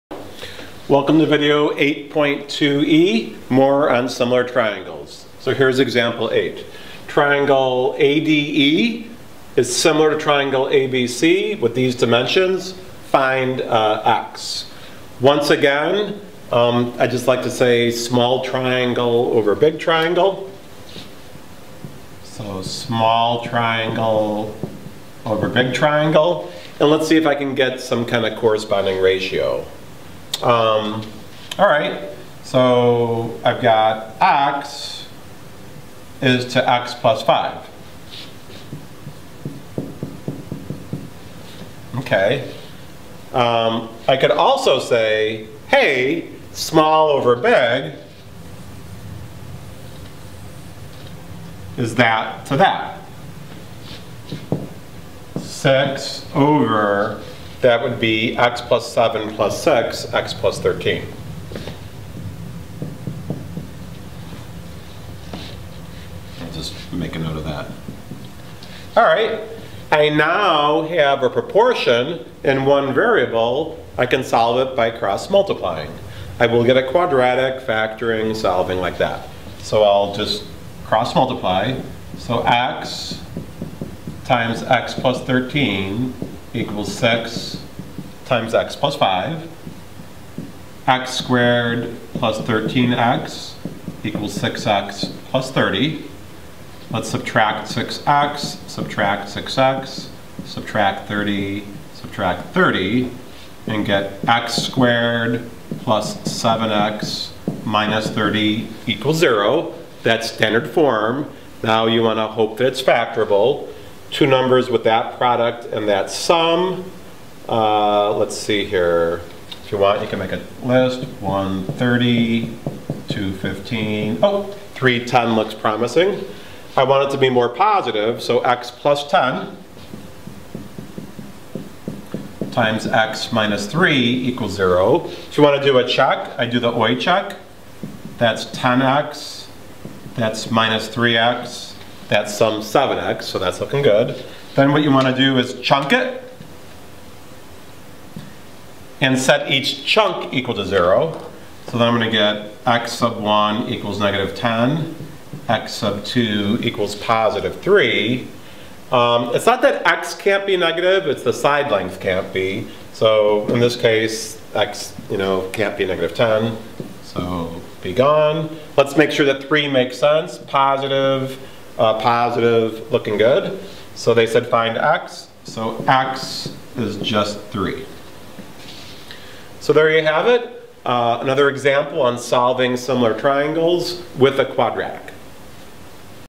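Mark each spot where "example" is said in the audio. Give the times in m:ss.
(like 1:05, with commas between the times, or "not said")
0:05, 3:01.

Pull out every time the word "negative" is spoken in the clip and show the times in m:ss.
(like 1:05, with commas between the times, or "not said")
2:34, 2:40, 2:45.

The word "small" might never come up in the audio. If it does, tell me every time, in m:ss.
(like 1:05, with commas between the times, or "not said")
0:17, 0:22, 0:46.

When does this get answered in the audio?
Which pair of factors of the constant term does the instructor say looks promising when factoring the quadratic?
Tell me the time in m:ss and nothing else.
2:04.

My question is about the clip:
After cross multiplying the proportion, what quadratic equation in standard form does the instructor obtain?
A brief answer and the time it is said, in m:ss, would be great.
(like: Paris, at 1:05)
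x^2 + 7x - 30 = 0, at 1:44.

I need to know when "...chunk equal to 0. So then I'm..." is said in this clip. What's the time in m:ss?
2:29.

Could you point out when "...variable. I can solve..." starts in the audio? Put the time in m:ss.
1:12.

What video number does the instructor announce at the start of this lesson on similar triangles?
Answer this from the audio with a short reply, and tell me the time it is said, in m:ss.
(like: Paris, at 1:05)
8.2e, at 0:01.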